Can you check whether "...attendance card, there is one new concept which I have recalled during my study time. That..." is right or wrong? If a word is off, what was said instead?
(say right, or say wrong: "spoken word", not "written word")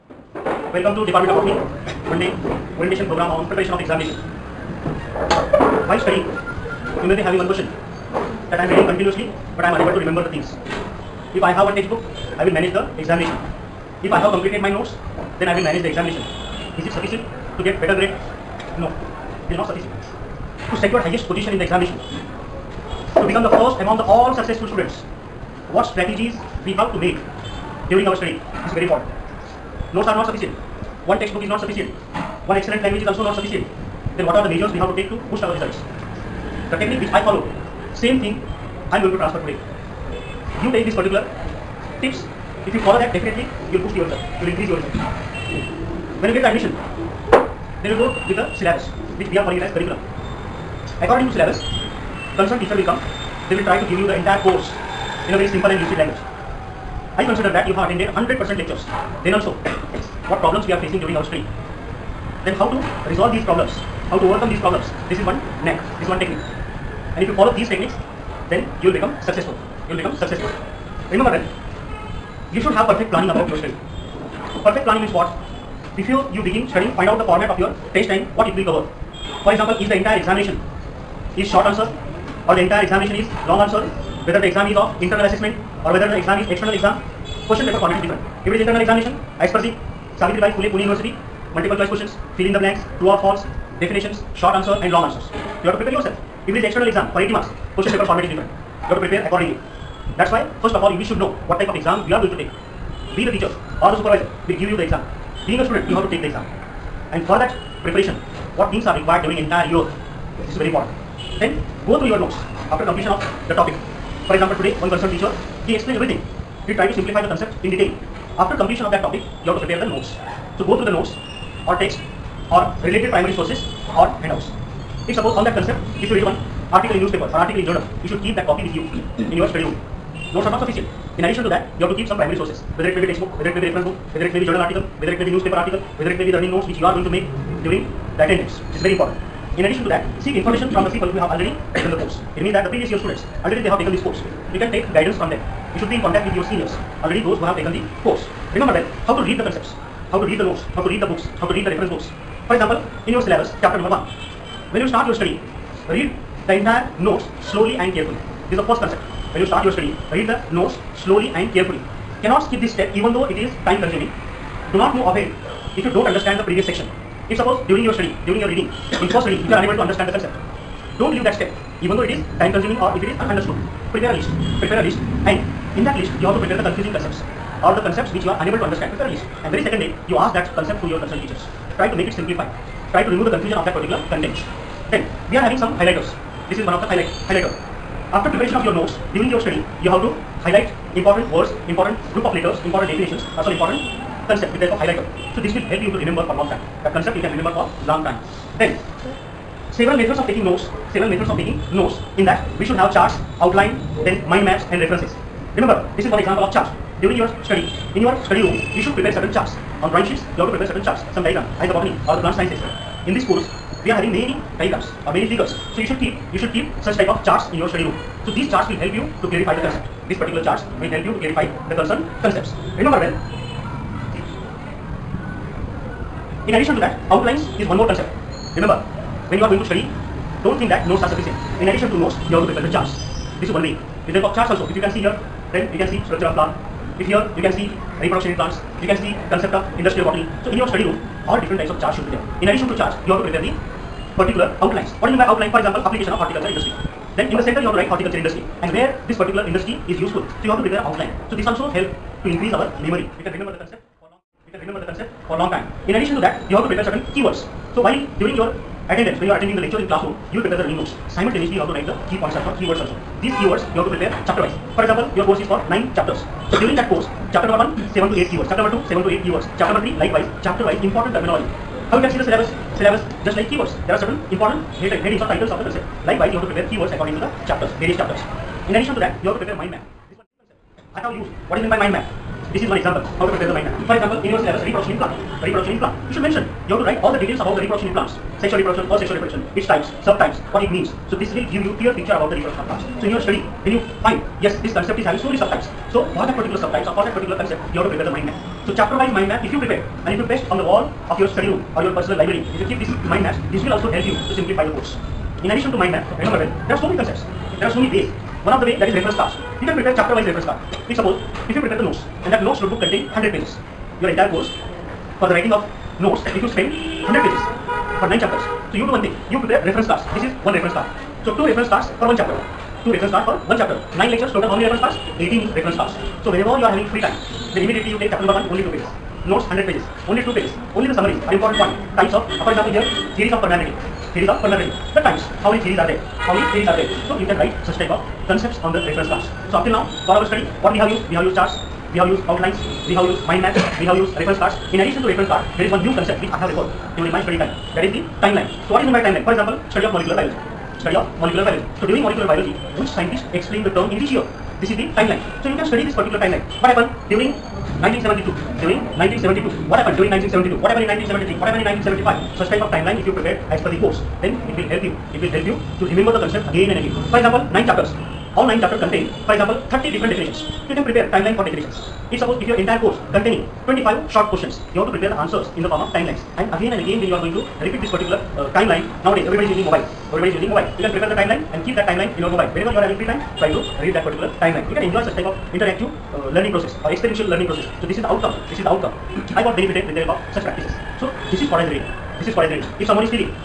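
wrong: "reference", not "attendance".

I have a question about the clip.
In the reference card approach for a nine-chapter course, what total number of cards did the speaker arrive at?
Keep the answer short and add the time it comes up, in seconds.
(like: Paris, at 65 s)
18, at 325 s.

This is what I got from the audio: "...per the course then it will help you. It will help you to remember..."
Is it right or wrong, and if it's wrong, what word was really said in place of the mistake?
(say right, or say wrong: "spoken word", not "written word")
right.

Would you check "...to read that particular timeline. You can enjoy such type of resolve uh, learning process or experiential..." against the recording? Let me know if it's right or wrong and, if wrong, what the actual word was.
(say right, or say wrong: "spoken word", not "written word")
wrong: "interactive", not "resolve".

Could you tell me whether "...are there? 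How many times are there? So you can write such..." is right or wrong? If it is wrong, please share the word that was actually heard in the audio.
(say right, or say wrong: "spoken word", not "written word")
wrong: "theories", not "times".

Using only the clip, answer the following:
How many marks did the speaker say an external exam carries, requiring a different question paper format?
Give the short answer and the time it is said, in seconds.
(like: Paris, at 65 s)
80, at 97 s.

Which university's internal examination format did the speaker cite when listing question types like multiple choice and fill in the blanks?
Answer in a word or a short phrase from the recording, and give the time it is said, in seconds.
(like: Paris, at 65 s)
Savitribai Phule Pune University, at 90 s.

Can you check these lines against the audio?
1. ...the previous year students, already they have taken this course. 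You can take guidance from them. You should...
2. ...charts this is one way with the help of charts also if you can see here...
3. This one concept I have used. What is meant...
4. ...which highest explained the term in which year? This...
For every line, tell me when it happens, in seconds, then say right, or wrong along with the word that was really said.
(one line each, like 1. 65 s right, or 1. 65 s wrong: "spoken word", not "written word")
1. 142 s right
2. 232 s right
3. 280 s right
4. 352 s wrong: "scientist", not "highest".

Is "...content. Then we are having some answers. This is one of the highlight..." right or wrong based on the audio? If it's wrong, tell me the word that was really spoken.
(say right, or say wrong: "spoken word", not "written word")
wrong: "highlighters", not "answers".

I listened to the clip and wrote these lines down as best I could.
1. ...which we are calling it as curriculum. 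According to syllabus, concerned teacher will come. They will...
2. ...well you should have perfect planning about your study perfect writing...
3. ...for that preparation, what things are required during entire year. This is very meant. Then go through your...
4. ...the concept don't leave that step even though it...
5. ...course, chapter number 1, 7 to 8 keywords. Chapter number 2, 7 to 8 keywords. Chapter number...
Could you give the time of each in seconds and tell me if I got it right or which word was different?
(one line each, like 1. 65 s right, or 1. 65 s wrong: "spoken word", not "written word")
1. 49 s right
2. 71 s wrong: "planning", not "writing"
3. 107 s wrong: "important", not "meant"
4. 170 s right
5. 266 s right.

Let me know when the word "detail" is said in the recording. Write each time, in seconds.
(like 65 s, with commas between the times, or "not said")
117 s, 287 s.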